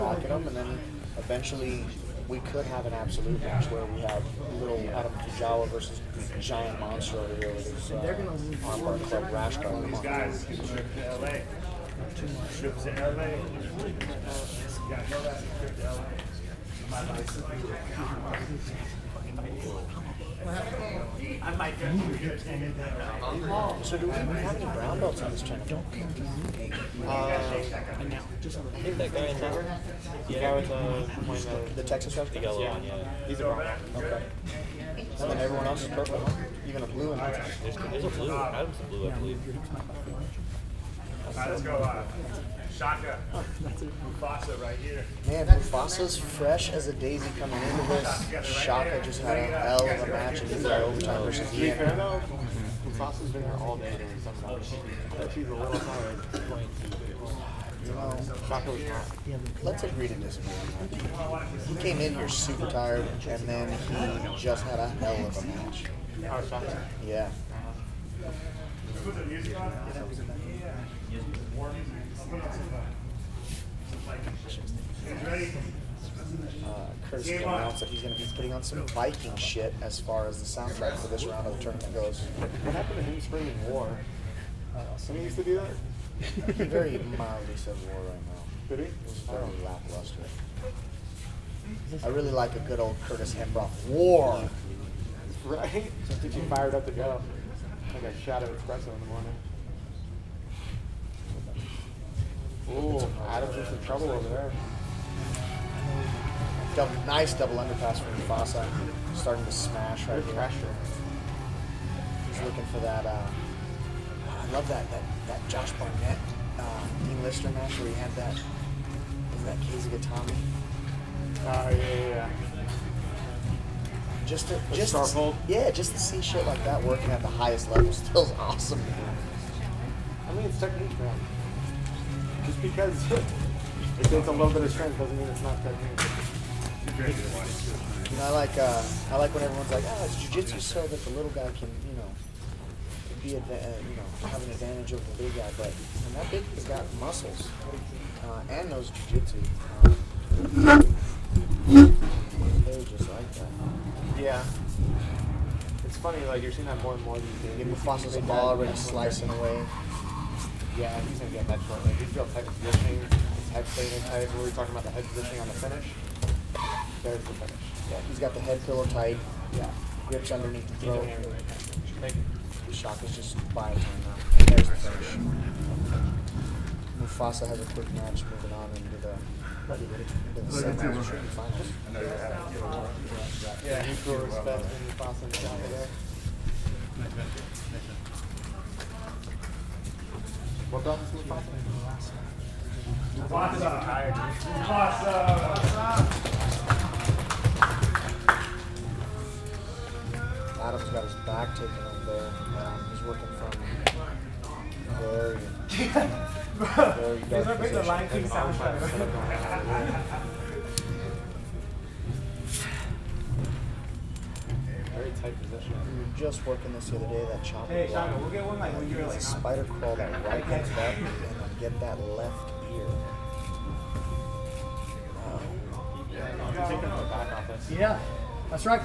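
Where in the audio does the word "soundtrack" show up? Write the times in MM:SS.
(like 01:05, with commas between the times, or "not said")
01:20, 03:28.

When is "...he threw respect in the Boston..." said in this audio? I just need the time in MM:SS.
03:03.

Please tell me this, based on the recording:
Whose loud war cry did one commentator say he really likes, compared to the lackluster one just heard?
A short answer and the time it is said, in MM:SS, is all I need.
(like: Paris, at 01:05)
Curtis Hembroff, at 01:33.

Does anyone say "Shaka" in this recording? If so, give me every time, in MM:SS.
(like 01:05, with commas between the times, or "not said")
00:42, 00:48, 03:37.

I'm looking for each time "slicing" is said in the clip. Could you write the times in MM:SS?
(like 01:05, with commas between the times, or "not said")
02:38.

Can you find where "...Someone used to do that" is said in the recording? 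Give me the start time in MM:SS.
01:24.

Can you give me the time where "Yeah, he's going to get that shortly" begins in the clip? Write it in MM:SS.
02:40.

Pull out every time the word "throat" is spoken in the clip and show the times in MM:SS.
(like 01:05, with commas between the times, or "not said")
02:50.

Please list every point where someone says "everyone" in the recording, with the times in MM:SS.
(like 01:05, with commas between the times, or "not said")
00:35, 02:19.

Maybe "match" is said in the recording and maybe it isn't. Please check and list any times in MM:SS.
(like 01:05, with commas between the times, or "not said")
00:03, 00:50, 01:05, 01:57, 02:57.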